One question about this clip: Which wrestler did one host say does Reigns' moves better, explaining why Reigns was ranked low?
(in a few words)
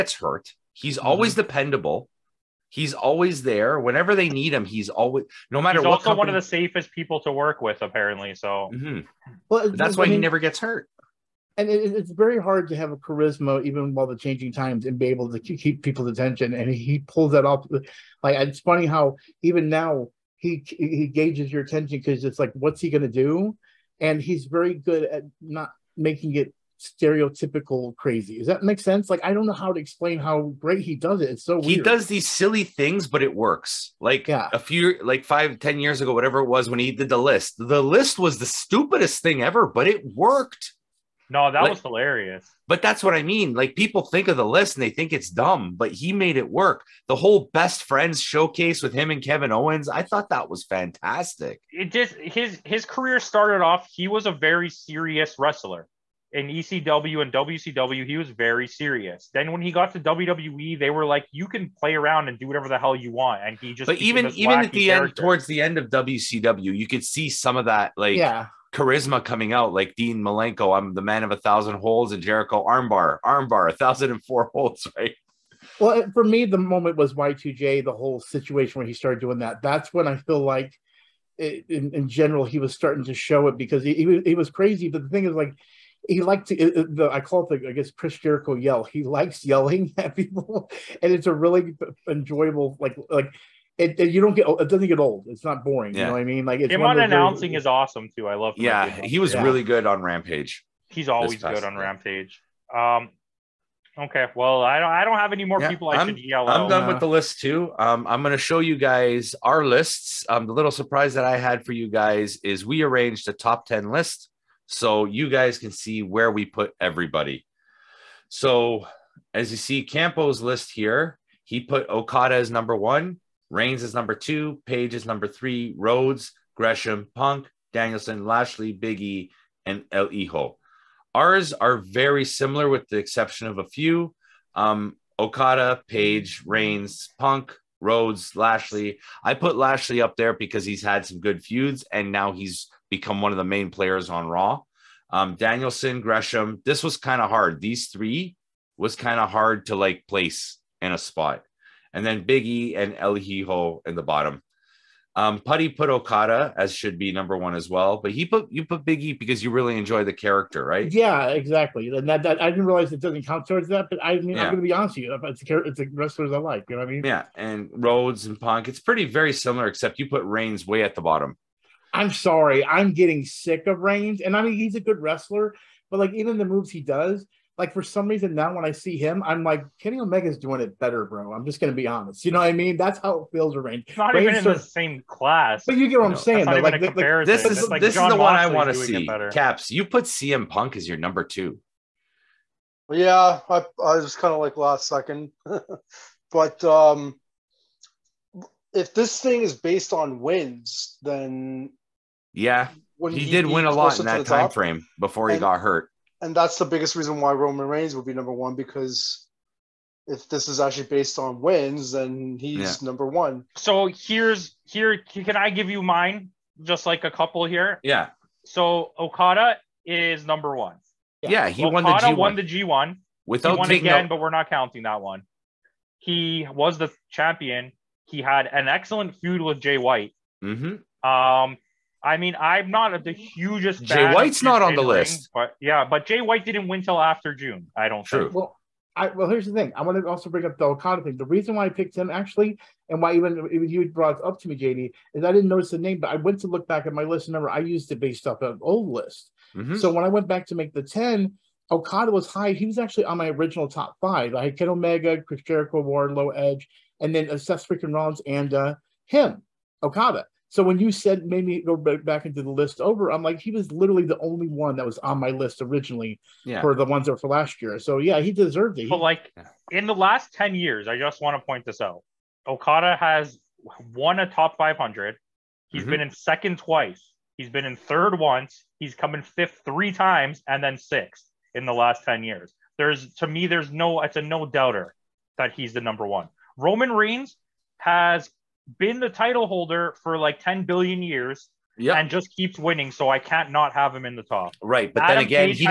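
Kenny Omega.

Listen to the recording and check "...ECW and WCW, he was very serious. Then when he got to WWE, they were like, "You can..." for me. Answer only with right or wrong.
right.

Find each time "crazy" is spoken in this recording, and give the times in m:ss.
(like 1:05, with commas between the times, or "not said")
0:27, 1:24.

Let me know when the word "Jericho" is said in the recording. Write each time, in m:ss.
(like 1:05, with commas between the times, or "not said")
1:12, 1:28, 4:15.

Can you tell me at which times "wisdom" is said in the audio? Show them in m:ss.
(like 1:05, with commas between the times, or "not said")
not said.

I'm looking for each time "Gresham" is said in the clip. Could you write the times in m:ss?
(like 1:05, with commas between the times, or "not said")
2:06, 2:25.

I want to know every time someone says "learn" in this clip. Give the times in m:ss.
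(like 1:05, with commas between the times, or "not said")
not said.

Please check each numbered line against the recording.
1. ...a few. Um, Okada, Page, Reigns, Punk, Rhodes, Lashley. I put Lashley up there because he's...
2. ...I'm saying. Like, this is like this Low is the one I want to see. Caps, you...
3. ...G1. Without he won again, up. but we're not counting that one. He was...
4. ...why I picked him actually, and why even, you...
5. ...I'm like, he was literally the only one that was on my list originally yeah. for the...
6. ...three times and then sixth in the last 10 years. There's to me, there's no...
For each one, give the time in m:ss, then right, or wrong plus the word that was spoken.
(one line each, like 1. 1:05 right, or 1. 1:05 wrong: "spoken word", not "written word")
1. 2:13 right
2. 3:06 wrong: "John", not "Low"
3. 3:42 right
4. 4:01 right
5. 4:23 right
6. 4:39 right.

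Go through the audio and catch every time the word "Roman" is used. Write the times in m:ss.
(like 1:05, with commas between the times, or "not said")
3:27, 4:46.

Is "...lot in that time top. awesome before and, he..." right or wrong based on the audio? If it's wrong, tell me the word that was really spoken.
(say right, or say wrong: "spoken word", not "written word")
wrong: "frame", not "awesome".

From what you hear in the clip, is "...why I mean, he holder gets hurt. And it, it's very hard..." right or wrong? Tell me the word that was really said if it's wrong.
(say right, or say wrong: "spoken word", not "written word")
wrong: "never", not "holder".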